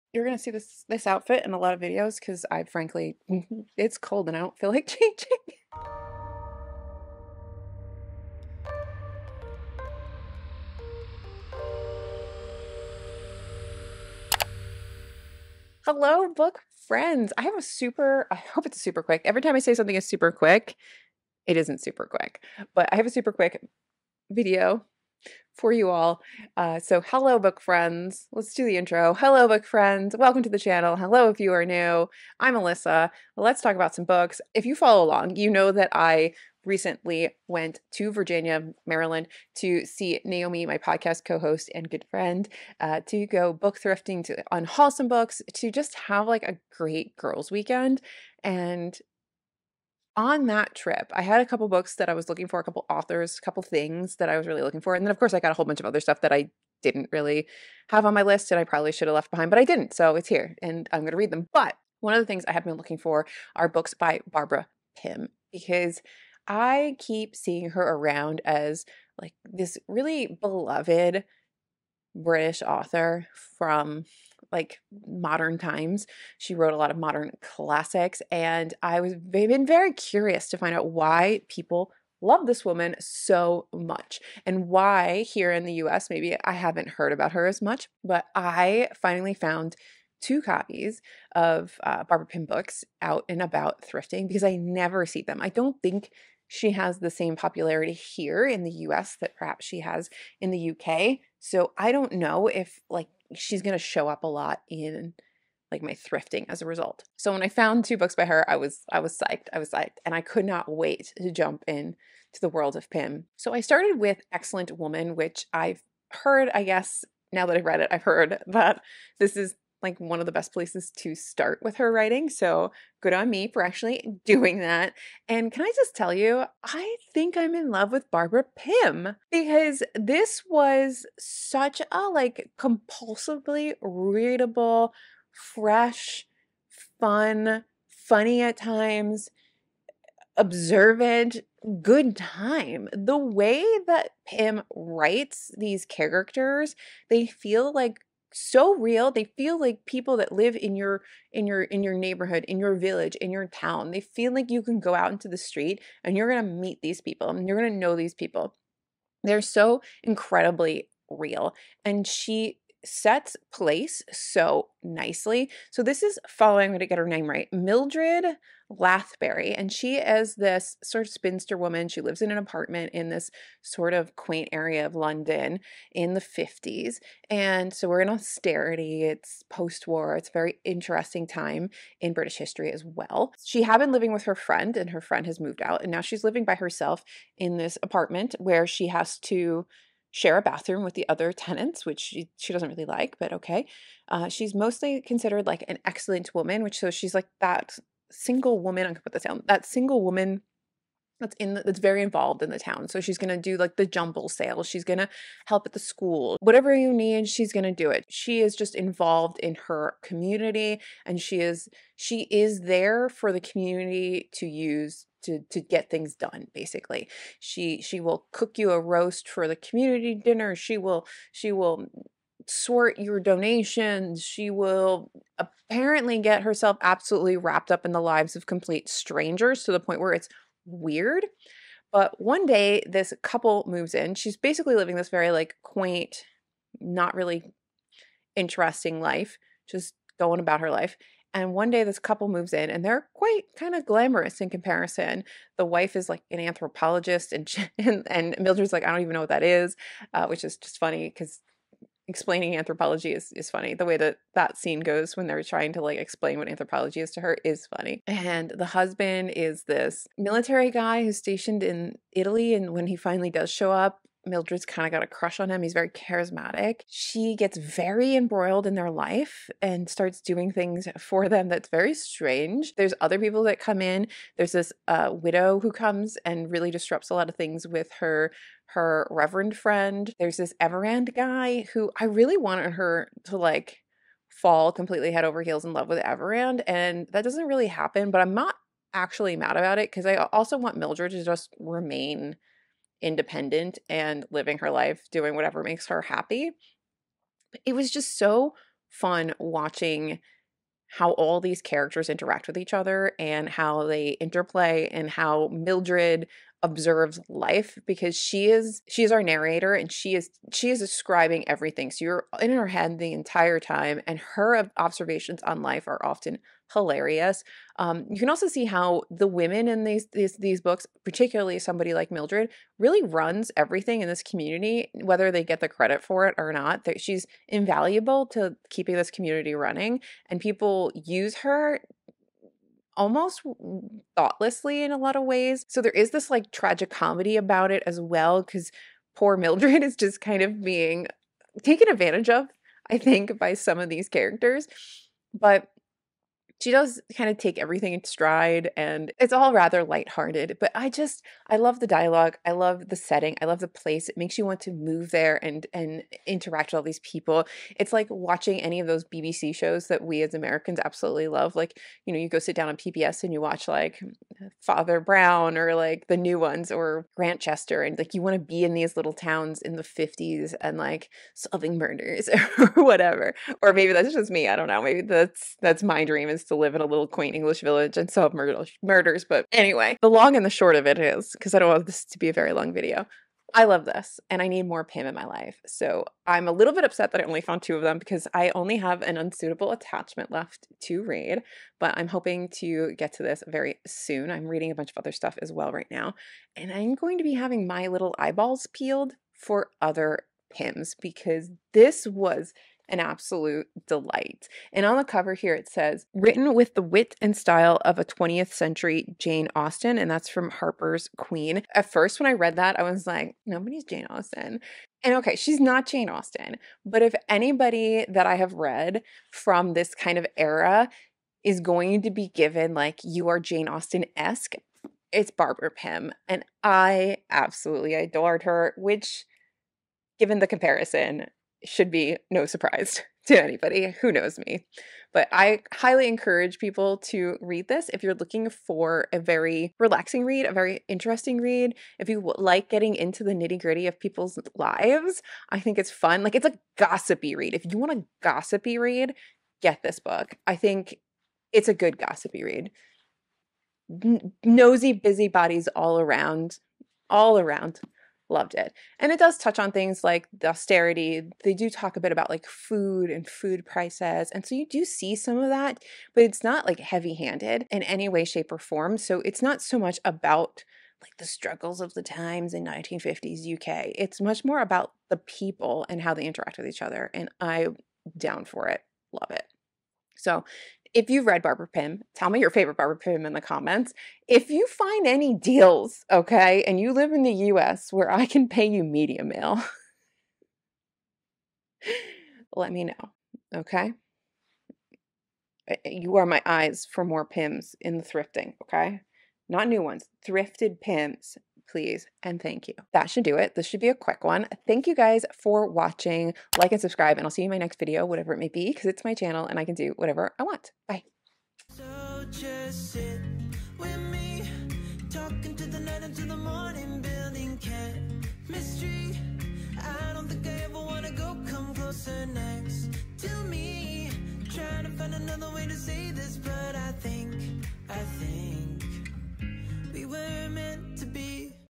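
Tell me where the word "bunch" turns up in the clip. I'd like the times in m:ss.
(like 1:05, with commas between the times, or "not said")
0:55, 6:34.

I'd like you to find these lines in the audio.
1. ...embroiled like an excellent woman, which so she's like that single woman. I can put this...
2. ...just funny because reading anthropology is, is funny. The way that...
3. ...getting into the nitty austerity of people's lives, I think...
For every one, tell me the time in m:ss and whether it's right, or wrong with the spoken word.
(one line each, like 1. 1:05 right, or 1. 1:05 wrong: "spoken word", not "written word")
1. 3:15 wrong: "considered", not "embroiled"
2. 4:10 wrong: "explaining", not "reading"
3. 7:22 wrong: "gritty", not "austerity".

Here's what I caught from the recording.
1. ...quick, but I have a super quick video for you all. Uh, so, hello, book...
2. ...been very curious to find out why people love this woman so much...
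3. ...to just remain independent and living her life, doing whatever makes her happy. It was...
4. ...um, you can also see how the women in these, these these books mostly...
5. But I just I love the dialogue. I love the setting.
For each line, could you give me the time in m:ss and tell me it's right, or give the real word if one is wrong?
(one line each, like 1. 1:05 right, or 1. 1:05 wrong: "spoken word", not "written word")
1. 0:22 right
2. 1:19 right
3. 4:51 right
4. 5:17 wrong: "particularly", not "mostly"
5. 5:50 right.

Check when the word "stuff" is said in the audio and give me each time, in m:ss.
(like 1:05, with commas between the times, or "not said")
0:56, 6:35.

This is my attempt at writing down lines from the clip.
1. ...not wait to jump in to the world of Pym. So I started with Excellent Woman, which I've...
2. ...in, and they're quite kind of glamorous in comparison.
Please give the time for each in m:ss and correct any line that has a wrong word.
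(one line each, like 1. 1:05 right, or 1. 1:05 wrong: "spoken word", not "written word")
1. 1:50 right
2. 4:02 right.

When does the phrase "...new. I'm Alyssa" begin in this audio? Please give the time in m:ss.
0:31.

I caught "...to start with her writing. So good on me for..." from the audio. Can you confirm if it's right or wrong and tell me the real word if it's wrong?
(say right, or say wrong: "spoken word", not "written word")
right.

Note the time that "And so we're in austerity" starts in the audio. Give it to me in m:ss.
2:57.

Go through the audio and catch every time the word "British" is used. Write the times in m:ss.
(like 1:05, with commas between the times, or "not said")
1:12, 3:02.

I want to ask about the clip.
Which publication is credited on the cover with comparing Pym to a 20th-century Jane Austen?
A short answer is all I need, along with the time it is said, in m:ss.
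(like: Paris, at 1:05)
Harper's Queen, at 6:50.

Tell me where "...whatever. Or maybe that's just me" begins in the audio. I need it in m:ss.
6:12.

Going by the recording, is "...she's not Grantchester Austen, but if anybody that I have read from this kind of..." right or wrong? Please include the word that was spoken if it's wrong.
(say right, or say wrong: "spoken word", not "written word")
wrong: "Jane", not "Grantchester".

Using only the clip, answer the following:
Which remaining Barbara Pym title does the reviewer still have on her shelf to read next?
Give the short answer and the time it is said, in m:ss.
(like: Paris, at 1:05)
An Unsuitable Attachment, at 6:29.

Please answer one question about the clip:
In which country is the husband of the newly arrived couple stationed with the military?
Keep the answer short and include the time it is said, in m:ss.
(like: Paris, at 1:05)
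Italy, at 4:22.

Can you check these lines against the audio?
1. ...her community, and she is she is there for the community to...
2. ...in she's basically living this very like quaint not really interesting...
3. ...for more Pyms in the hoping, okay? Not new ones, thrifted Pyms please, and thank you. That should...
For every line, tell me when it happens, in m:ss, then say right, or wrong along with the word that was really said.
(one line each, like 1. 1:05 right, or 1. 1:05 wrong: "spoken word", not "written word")
1. 3:29 right
2. 3:53 right
3. 8:16 wrong: "thrifting", not "hoping".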